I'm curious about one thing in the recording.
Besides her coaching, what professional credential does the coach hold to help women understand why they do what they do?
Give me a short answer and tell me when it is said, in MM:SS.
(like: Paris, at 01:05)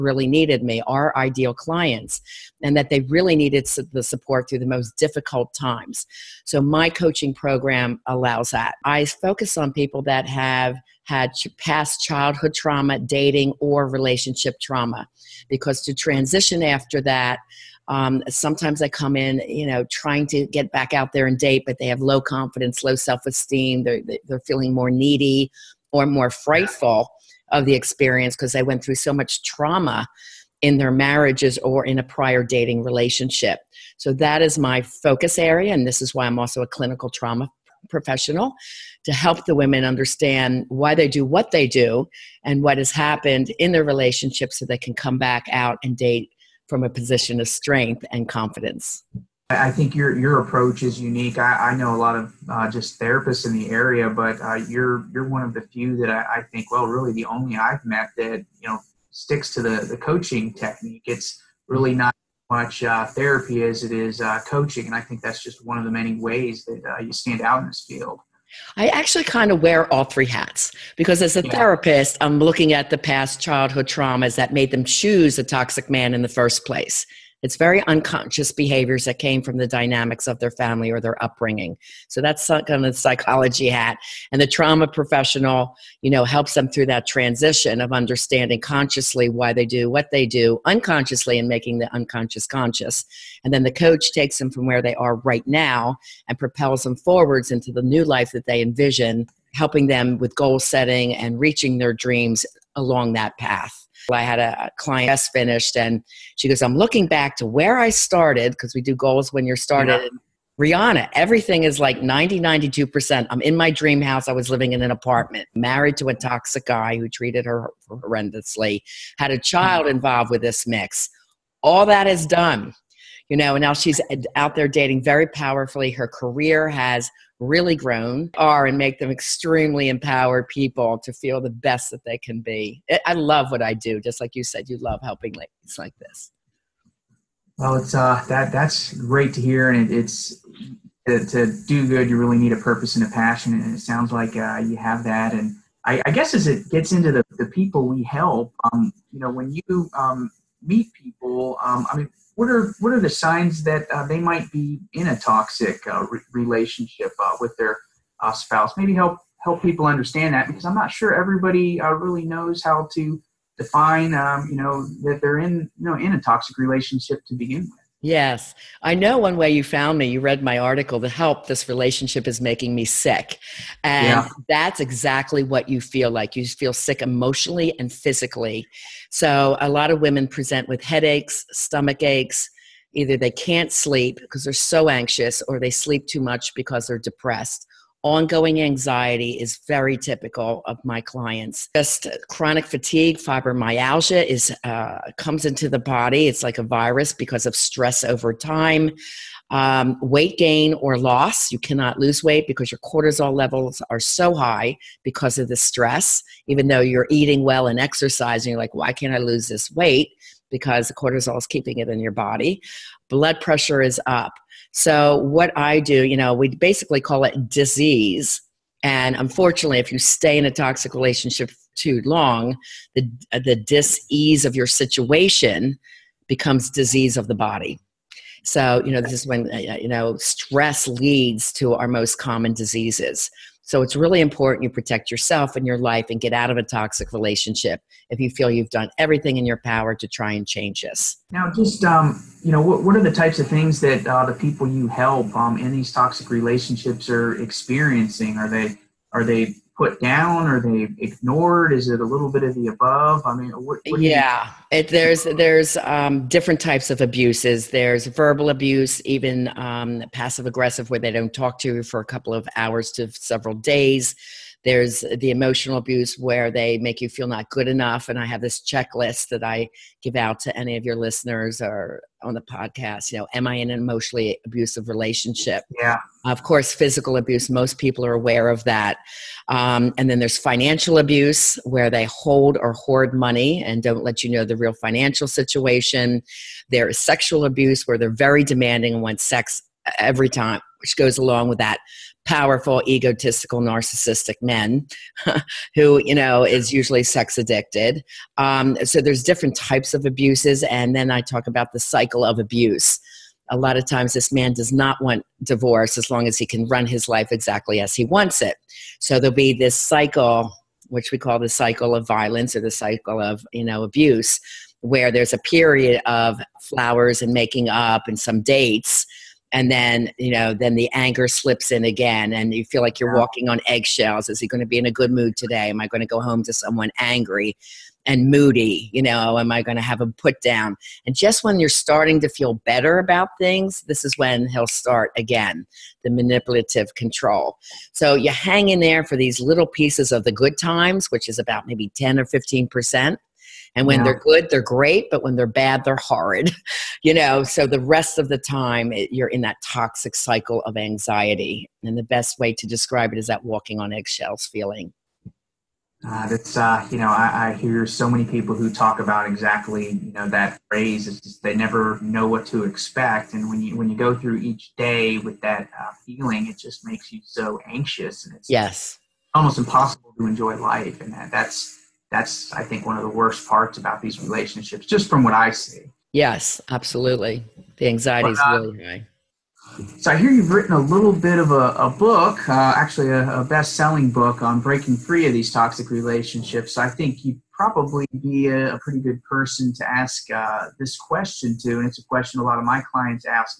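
Clinical trauma professional, at 00:36.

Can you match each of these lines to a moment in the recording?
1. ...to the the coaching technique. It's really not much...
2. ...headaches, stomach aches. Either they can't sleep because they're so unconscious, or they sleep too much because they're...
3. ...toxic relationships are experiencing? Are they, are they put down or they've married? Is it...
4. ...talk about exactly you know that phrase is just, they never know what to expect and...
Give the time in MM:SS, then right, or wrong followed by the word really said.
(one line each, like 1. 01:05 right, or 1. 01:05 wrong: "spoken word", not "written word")
1. 00:59 right
2. 03:00 wrong: "anxious", not "unconscious"
3. 04:05 wrong: "ignored", not "married"
4. 05:58 right.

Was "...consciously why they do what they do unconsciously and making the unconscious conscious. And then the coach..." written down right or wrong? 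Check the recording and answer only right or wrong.
right.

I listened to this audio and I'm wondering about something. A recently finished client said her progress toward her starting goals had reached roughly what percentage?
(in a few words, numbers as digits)
92%.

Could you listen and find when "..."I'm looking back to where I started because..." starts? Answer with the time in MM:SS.
01:46.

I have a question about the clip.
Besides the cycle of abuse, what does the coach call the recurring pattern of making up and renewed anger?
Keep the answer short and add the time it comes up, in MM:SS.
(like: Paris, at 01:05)
Cycle of violence, at 05:11.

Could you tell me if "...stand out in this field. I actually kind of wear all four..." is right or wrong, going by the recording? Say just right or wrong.
wrong.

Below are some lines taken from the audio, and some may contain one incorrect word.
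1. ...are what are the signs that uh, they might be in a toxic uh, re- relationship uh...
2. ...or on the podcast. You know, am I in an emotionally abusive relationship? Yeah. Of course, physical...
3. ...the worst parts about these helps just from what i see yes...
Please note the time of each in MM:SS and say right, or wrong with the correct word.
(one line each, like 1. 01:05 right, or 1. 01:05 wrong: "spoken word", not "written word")
1. 02:32 right
2. 04:31 right
3. 06:13 wrong: "relationships", not "helps".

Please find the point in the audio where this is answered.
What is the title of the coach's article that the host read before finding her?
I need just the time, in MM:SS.
02:50.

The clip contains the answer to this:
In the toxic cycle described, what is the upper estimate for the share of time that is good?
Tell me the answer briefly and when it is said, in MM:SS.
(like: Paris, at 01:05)
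15 percent, at 05:42.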